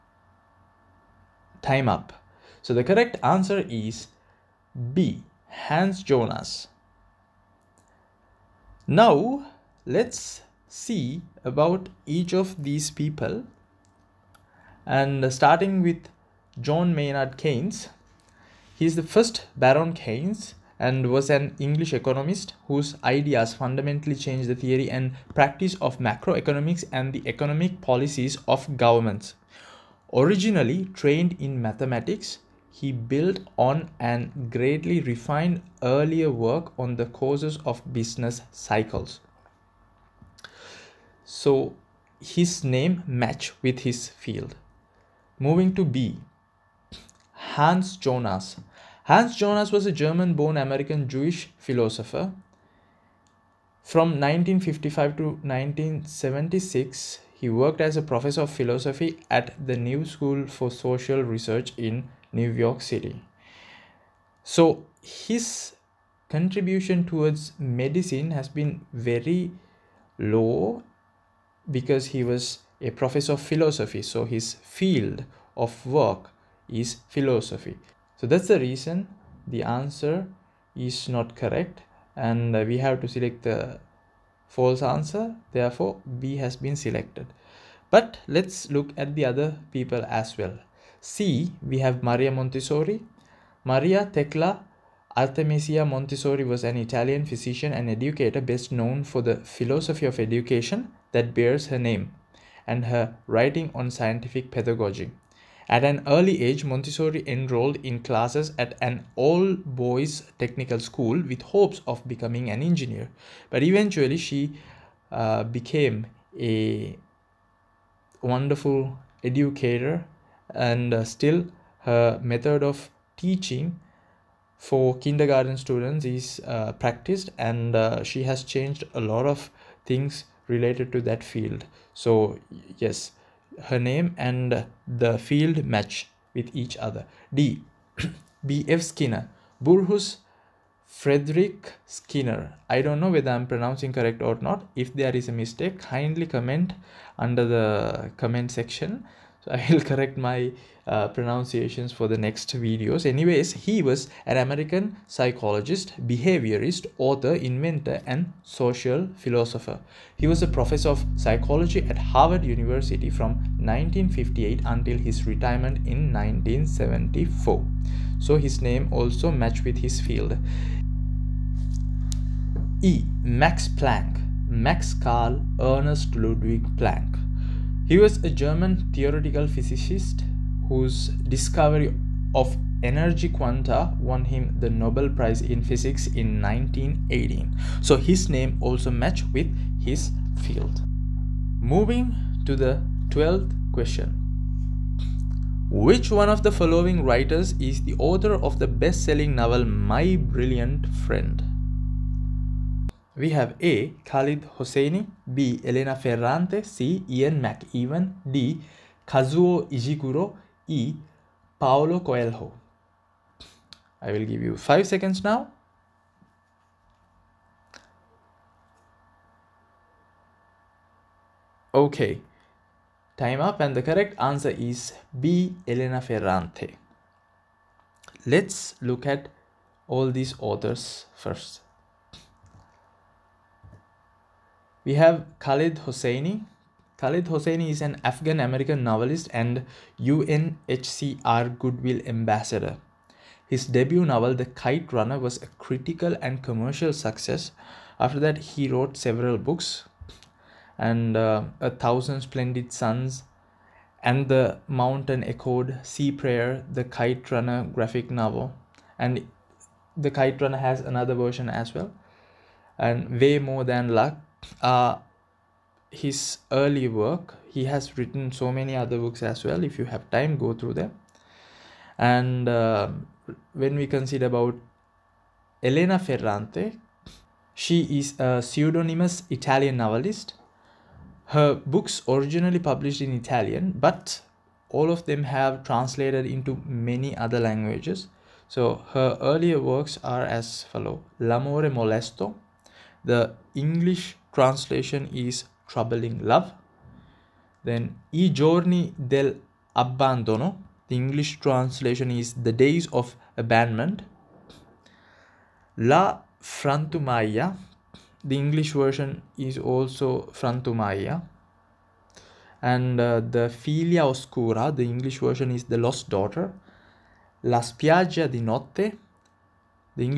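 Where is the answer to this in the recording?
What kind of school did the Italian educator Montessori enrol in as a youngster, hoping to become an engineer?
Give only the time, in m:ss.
1:49.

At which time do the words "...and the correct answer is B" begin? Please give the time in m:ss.
3:43.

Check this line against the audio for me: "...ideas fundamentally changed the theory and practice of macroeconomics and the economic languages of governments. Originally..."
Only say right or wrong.
wrong.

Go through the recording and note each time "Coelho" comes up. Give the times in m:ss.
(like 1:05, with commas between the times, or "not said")
3:31.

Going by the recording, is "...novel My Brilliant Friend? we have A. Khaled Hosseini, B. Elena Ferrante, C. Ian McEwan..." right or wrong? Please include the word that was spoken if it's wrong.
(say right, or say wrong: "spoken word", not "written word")
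right.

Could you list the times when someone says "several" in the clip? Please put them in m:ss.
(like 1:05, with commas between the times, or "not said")
4:08.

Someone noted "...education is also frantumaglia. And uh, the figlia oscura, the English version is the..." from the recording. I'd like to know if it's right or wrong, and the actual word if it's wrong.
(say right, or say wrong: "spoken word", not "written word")
wrong: "version", not "education".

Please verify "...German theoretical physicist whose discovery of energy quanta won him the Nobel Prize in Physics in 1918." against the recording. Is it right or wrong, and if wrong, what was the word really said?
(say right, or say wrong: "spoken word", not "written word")
right.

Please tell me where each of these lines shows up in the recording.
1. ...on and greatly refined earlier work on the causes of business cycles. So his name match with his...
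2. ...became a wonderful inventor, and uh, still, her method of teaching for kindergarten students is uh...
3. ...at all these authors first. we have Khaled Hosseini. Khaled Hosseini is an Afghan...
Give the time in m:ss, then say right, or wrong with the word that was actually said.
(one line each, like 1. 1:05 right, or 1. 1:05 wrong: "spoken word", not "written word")
1. 0:33 right
2. 1:55 wrong: "educator", not "inventor"
3. 3:49 right.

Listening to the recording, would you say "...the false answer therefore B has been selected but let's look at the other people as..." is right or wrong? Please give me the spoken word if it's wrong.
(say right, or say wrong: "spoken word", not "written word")
right.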